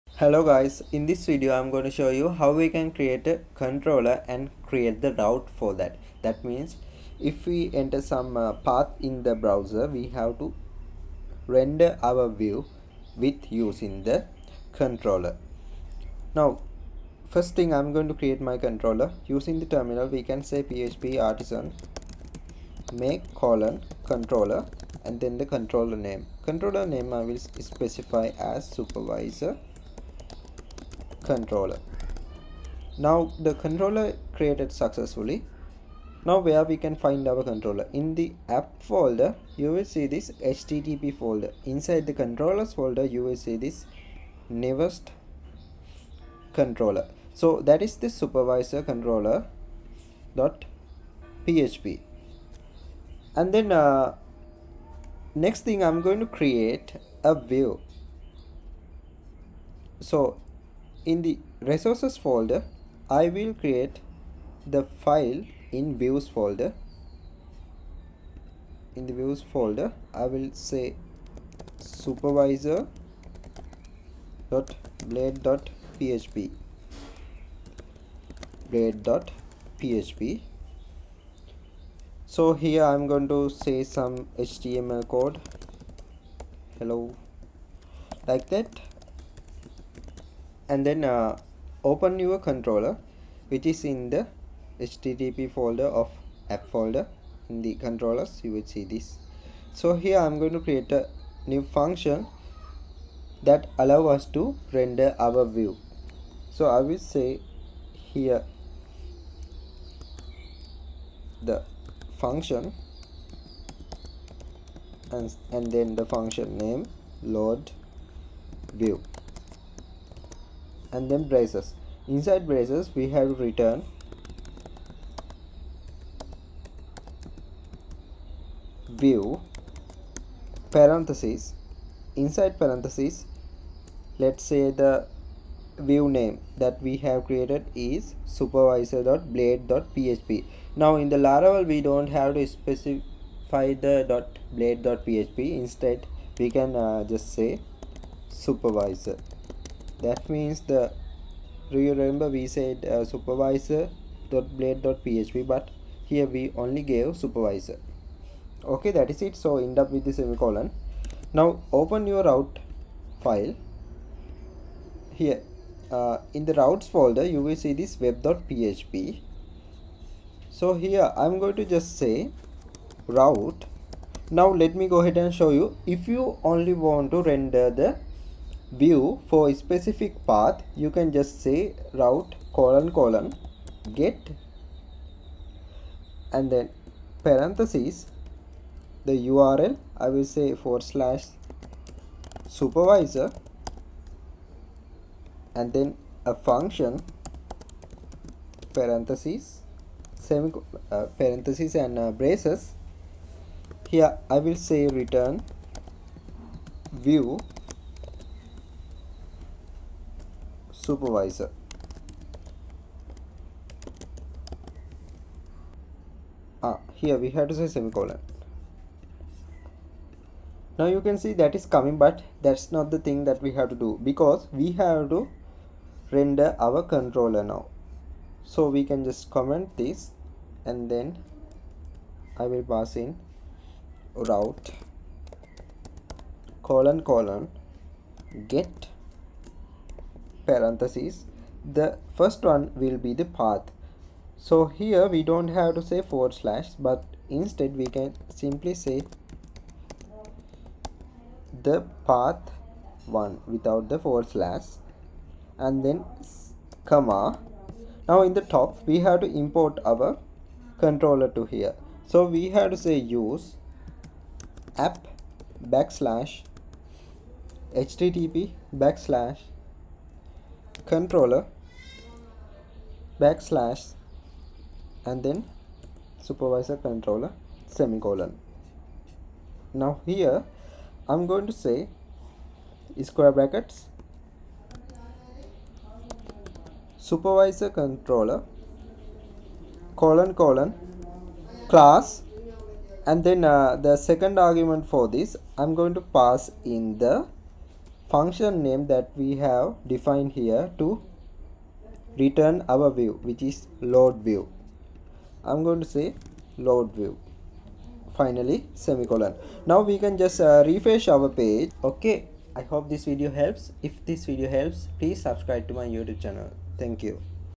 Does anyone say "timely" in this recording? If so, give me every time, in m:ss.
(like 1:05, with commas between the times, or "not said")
not said.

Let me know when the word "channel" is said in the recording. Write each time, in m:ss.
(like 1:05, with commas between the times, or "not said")
5:16.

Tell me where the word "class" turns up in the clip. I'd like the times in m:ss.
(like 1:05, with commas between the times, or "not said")
4:51.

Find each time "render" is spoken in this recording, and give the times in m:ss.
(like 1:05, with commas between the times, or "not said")
0:11, 1:44, 2:57, 3:46.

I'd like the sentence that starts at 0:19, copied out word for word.
Using the terminal we can say php artisan make colon controller and then the controller name.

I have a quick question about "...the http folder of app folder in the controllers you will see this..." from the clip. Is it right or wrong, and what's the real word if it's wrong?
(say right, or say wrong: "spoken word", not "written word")
right.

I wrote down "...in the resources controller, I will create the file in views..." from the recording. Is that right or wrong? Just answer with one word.
wrong.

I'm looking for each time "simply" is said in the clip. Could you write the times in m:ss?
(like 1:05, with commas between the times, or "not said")
4:08.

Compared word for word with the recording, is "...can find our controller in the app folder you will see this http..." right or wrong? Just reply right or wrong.
right.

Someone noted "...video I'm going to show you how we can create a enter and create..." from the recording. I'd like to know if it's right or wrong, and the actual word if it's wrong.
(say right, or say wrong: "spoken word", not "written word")
wrong: "controller", not "enter".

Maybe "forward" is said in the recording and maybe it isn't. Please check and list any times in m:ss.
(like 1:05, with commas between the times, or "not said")
4:06, 4:13.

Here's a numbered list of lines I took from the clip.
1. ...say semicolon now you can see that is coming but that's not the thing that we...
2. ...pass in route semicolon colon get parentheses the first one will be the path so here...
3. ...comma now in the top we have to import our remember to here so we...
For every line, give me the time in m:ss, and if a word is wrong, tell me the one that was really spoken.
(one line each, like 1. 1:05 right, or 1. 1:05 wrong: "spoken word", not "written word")
1. 3:37 right
2. 3:52 wrong: "colon", not "semicolon"
3. 4:16 wrong: "controller", not "remember".